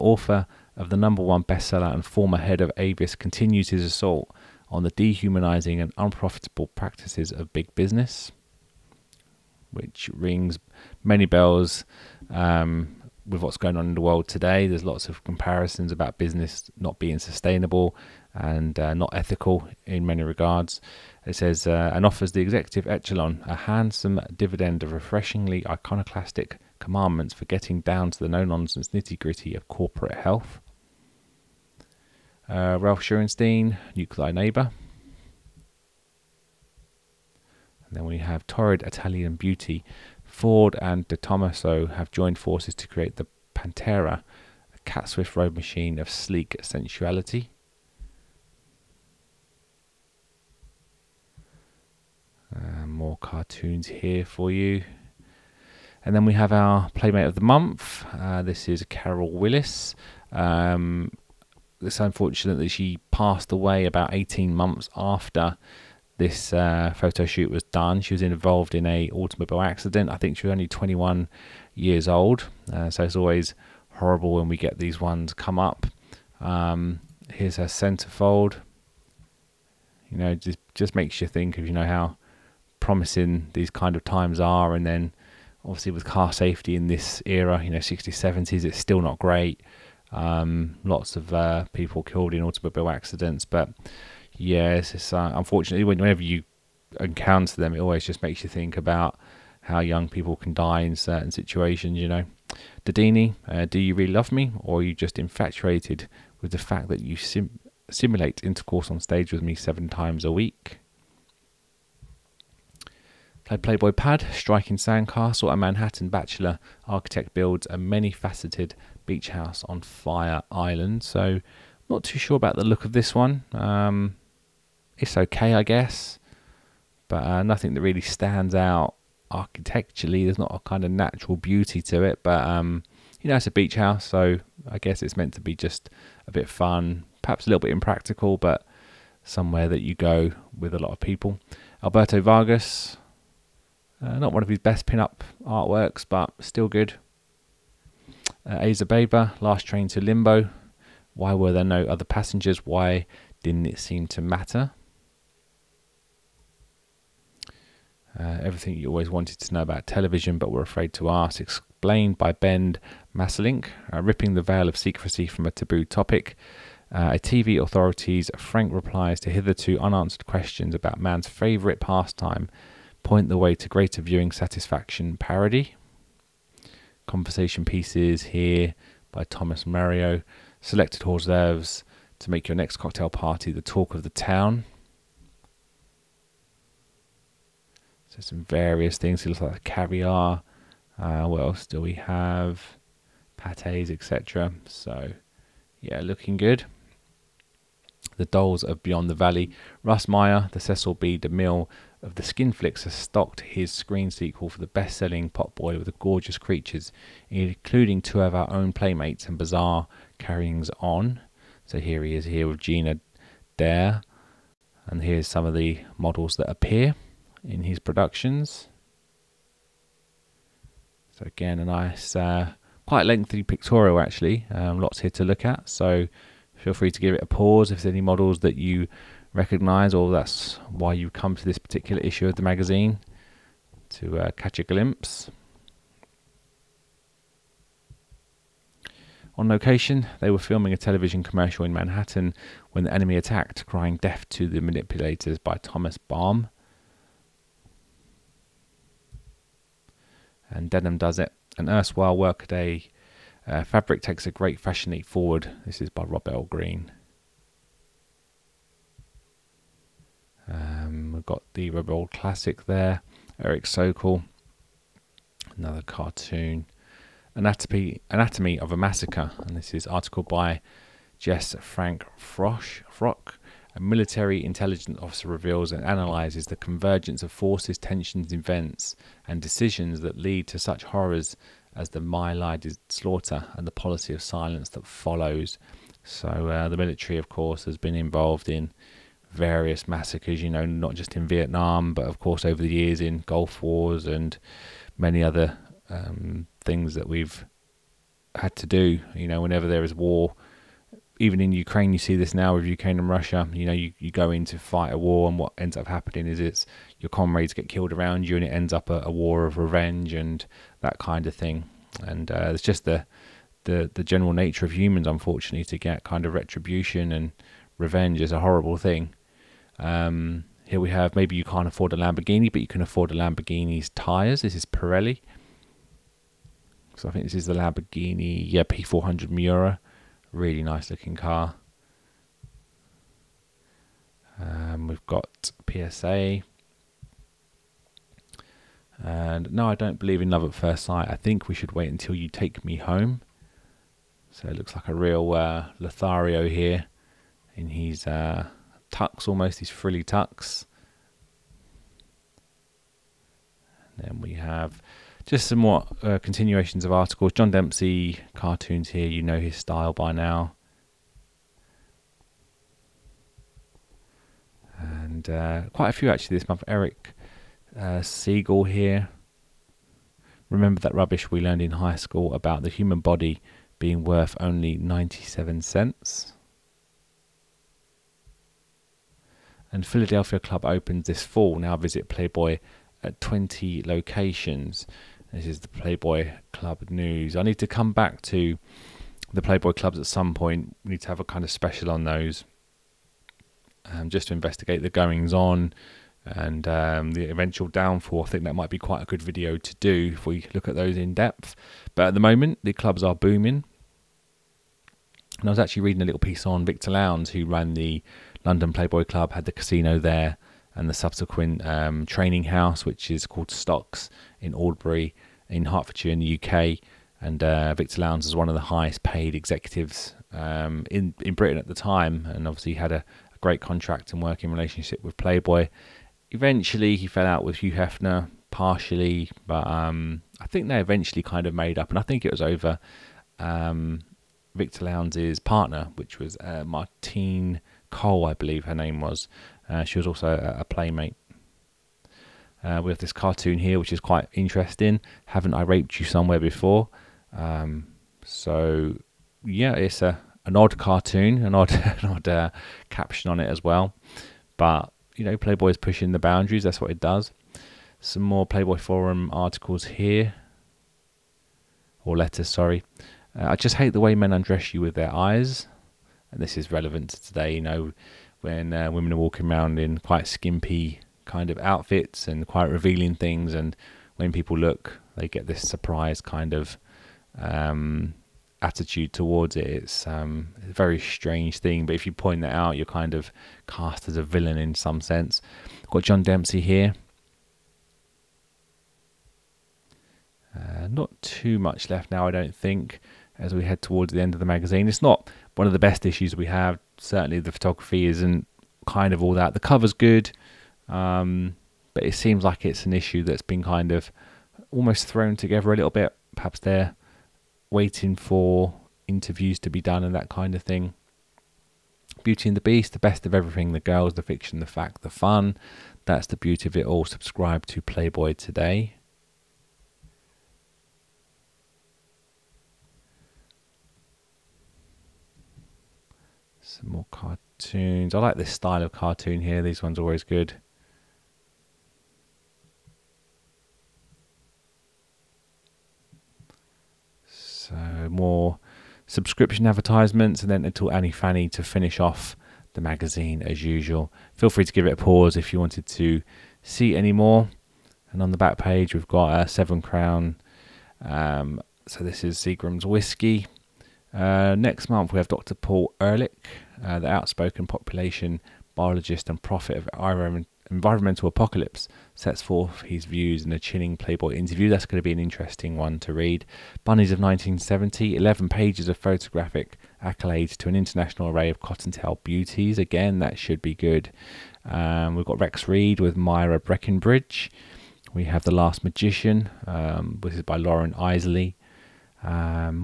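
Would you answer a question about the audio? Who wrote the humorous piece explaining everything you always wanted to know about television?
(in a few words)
Ben Masselink.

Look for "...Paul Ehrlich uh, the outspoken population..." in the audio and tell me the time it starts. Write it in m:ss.
9:15.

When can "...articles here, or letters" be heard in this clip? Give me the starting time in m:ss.
7:39.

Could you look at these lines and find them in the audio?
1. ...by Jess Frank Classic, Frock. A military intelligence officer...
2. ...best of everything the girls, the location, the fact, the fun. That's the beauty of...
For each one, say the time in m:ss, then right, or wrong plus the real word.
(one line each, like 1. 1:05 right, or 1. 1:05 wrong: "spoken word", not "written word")
1. 4:30 wrong: "Frosch", not "Classic"
2. 8:32 wrong: "fiction", not "location".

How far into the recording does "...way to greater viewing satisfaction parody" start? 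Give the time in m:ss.
2:53.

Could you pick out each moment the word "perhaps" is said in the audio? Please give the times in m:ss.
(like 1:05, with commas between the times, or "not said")
2:17, 8:26.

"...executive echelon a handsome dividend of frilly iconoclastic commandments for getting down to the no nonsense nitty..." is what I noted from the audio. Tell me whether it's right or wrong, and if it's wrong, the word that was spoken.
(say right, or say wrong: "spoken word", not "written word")
wrong: "refreshingly", not "frilly".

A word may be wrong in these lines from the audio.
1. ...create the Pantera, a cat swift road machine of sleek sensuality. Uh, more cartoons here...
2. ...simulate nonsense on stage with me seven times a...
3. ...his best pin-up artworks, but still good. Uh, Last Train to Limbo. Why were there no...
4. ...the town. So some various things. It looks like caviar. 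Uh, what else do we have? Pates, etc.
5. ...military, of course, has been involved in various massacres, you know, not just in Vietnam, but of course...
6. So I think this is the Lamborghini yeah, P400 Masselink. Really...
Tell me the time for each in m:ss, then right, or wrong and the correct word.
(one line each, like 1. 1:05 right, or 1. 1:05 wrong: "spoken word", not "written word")
1. 0:42 right
2. 1:47 wrong: "intercourse", not "nonsense"
3. 2:24 right
4. 3:04 right
5. 4:46 right
6. 5:26 wrong: "Miura", not "Masselink".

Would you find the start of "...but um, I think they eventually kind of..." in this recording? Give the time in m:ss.
7:09.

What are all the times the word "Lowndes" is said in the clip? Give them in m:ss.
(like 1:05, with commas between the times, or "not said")
6:46, 6:58, 7:14.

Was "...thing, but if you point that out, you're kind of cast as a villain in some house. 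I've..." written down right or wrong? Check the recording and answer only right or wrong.
wrong.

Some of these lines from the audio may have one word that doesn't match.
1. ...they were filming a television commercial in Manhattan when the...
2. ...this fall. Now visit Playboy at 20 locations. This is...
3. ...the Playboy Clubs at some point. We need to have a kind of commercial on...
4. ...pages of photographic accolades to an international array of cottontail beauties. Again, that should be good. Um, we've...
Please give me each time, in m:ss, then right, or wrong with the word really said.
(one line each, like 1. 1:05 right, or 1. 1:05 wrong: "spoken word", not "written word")
1. 4:00 right
2. 6:21 right
3. 6:29 wrong: "special", not "commercial"
4. 9:28 right.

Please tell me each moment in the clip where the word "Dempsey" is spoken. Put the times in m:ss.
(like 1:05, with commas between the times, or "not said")
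5:57, 8:06.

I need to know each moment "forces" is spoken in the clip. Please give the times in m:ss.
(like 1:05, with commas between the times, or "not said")
0:42, 4:37.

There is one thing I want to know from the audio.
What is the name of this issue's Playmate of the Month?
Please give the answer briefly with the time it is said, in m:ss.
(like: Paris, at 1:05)
Carol Willis, at 0:58.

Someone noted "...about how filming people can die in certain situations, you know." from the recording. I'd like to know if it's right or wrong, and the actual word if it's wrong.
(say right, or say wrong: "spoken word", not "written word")
wrong: "young", not "filming".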